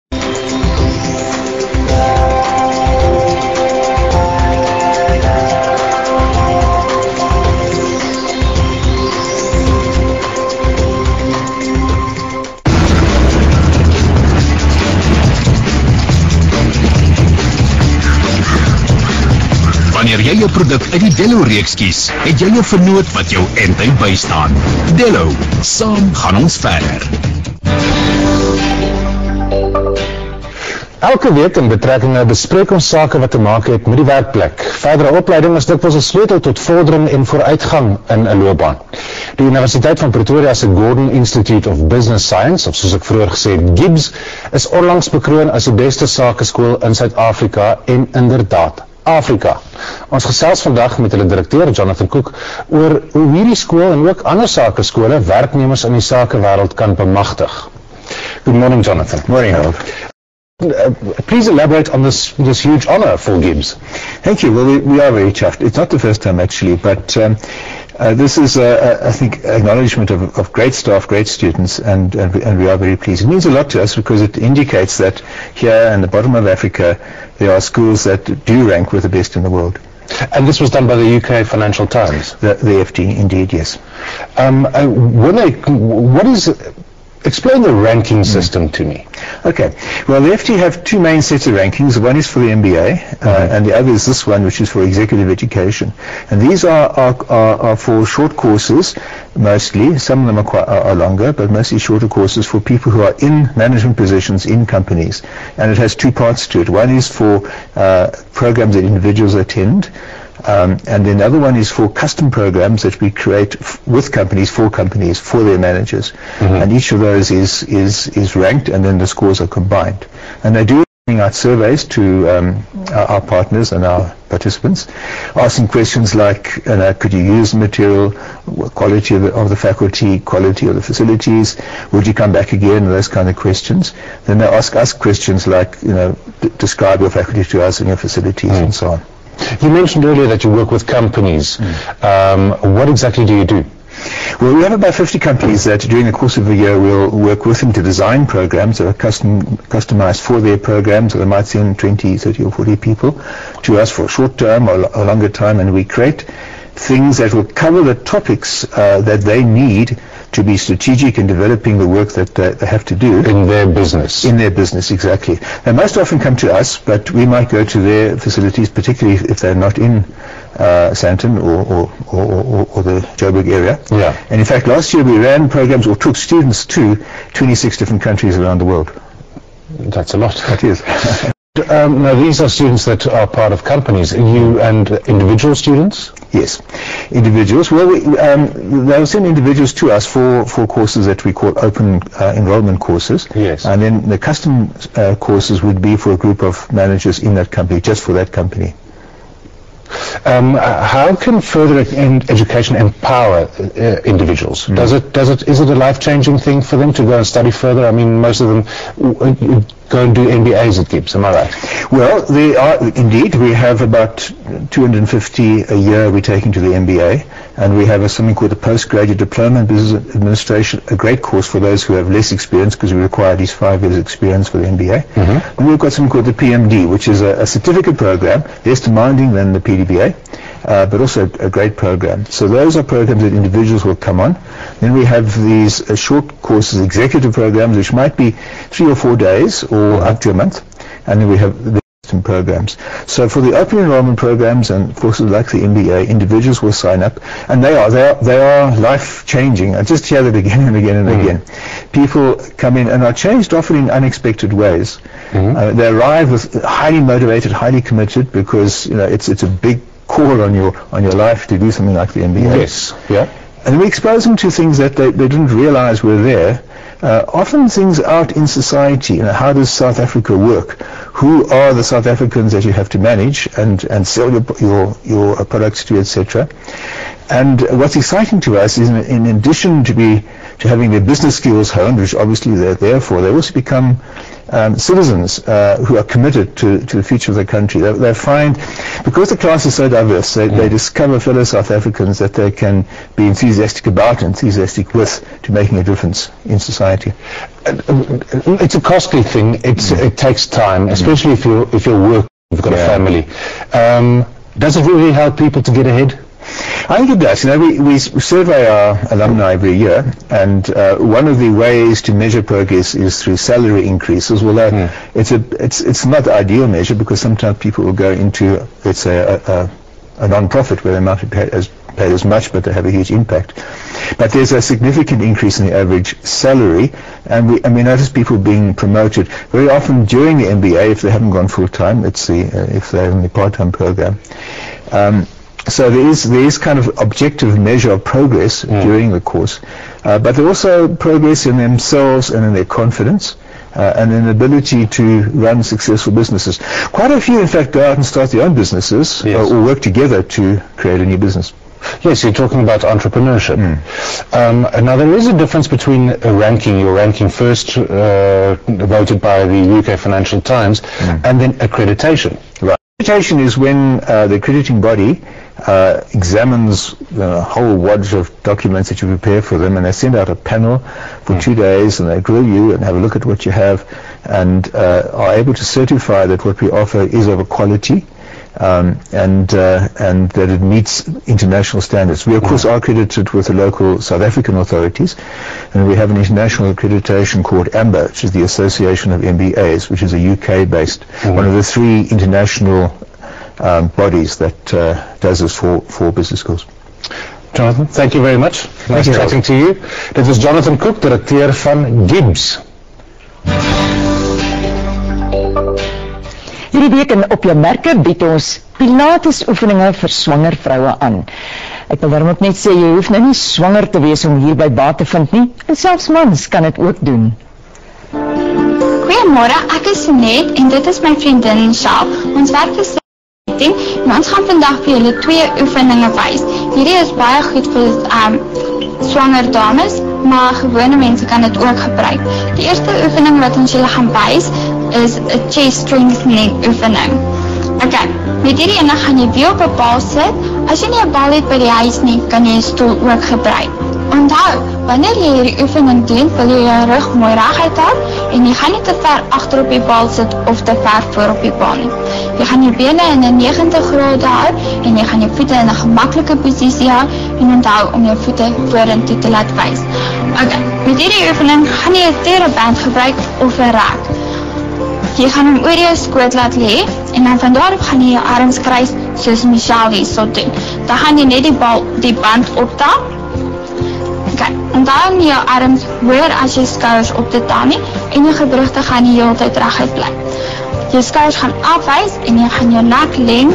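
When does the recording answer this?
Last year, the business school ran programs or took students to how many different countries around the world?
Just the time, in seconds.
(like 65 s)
177 s.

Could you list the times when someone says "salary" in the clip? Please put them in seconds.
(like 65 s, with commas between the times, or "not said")
313 s, 326 s.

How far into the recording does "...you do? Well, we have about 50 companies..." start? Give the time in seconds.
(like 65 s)
143 s.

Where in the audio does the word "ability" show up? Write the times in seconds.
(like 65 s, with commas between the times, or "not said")
344 s.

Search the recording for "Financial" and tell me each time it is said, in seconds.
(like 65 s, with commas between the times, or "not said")
81 s, 359 s.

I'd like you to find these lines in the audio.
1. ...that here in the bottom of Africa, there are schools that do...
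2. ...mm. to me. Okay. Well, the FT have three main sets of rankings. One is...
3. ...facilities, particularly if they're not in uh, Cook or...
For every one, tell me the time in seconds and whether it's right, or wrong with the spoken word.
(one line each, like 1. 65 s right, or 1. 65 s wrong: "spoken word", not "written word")
1. 74 s right
2. 88 s wrong: "two", not "three"
3. 168 s wrong: "Sandton", not "Cook".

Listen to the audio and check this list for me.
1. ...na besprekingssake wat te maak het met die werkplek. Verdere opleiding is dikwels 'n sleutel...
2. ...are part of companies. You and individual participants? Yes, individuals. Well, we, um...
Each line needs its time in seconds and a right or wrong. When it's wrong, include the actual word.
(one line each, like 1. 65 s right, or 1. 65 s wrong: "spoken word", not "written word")
1. 32 s right
2. 183 s wrong: "students", not "participants".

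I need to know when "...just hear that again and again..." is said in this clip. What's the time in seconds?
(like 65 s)
249 s.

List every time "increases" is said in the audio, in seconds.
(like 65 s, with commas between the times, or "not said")
313 s, 325 s.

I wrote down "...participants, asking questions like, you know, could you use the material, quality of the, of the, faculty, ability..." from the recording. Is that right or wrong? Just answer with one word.
wrong.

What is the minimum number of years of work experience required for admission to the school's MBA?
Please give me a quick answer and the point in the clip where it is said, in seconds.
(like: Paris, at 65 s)
5, at 223 s.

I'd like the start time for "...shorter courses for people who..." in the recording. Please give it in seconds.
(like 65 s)
101 s.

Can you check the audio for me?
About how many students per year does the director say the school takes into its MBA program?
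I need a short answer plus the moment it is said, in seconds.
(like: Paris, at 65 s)
250, at 213 s.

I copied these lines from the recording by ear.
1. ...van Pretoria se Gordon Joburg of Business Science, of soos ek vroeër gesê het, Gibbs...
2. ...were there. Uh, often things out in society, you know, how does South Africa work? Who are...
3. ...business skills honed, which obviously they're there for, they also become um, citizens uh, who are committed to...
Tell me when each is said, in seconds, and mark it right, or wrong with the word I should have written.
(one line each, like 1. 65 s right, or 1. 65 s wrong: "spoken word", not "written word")
1. 40 s wrong: "Institute", not "Joburg"
2. 266 s right
3. 281 s right.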